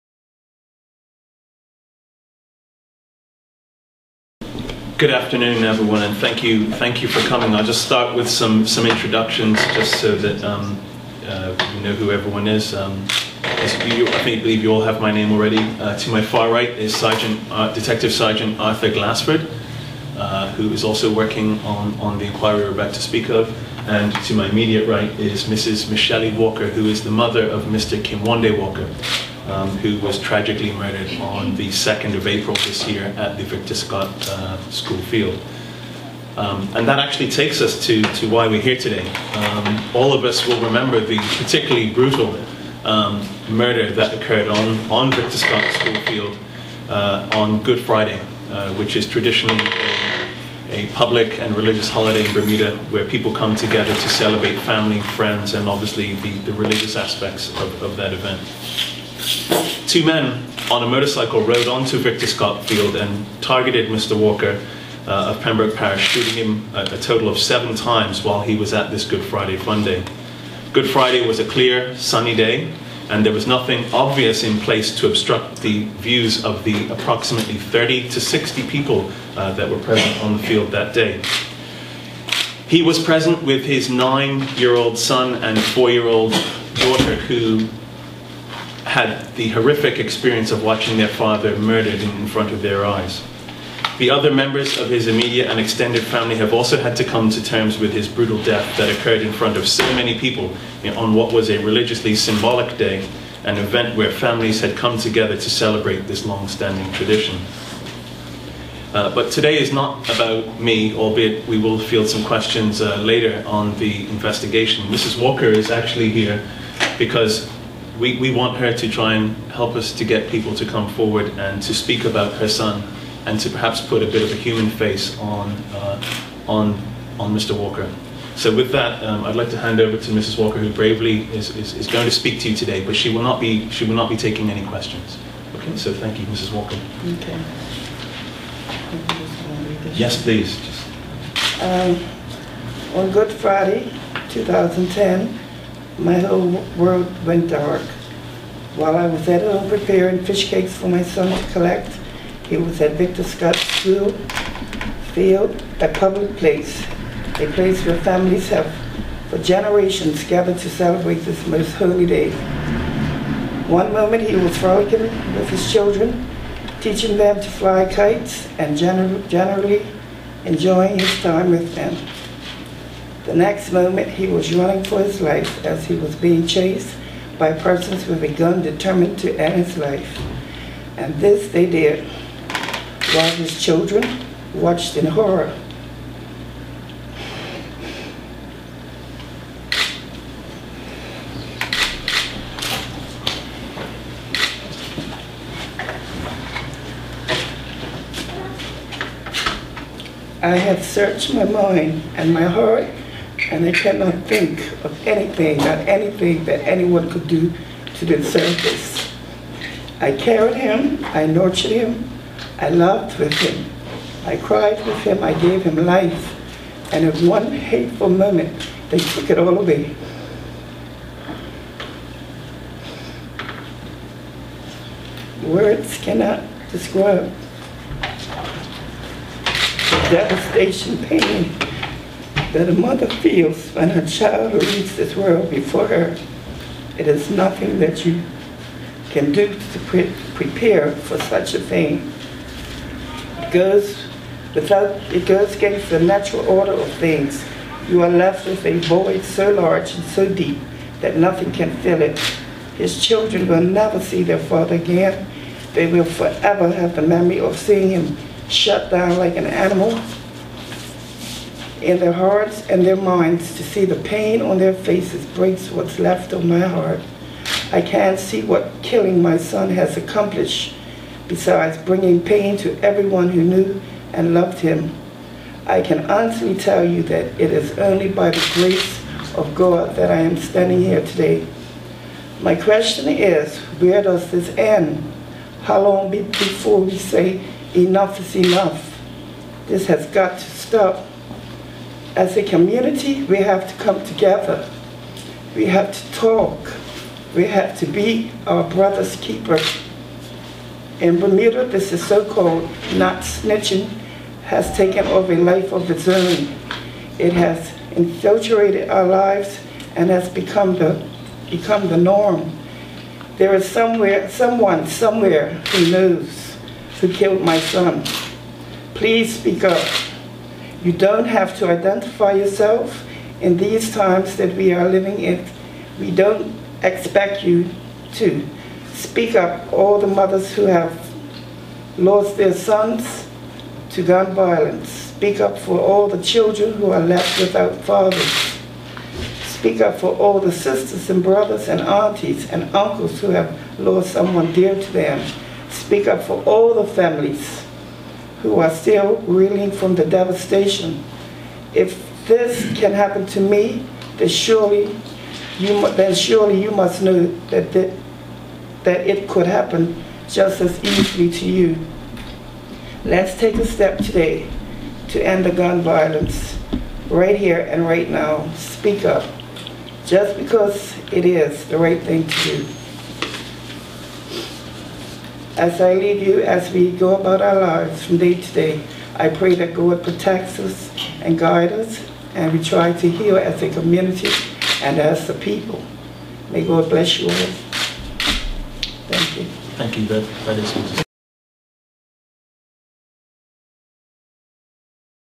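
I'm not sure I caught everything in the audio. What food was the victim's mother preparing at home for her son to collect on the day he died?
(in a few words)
fish cakes.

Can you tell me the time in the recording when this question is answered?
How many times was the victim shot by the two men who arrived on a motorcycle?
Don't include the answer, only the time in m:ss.
1:07.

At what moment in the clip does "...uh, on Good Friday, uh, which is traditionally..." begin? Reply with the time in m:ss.
0:46.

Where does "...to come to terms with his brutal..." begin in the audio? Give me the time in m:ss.
1:36.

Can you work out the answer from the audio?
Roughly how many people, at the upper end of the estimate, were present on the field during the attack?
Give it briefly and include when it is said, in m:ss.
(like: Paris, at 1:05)
60, at 1:18.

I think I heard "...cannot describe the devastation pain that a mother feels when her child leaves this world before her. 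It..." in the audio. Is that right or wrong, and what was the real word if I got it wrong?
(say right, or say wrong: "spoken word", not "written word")
right.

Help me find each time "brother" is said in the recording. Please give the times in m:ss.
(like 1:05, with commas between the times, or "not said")
4:58, 5:41.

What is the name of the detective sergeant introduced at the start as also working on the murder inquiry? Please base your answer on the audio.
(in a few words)
Arthur Glassford.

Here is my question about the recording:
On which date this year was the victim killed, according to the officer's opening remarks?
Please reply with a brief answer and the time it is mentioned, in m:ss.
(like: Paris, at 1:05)
2nd of April, at 0:31.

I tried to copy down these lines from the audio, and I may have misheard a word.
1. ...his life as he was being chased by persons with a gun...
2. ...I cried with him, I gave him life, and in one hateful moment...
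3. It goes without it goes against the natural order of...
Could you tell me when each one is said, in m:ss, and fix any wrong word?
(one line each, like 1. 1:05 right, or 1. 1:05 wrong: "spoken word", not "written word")
1. 2:54 right
2. 3:34 right
3. 4:03 right.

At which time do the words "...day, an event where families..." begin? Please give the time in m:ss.
1:42.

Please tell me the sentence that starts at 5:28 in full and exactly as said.
Speak up, all the mothers who have lost their sons to gun violence.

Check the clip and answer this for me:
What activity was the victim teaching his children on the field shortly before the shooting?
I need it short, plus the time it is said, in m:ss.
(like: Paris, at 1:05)
to fly kites, at 2:47.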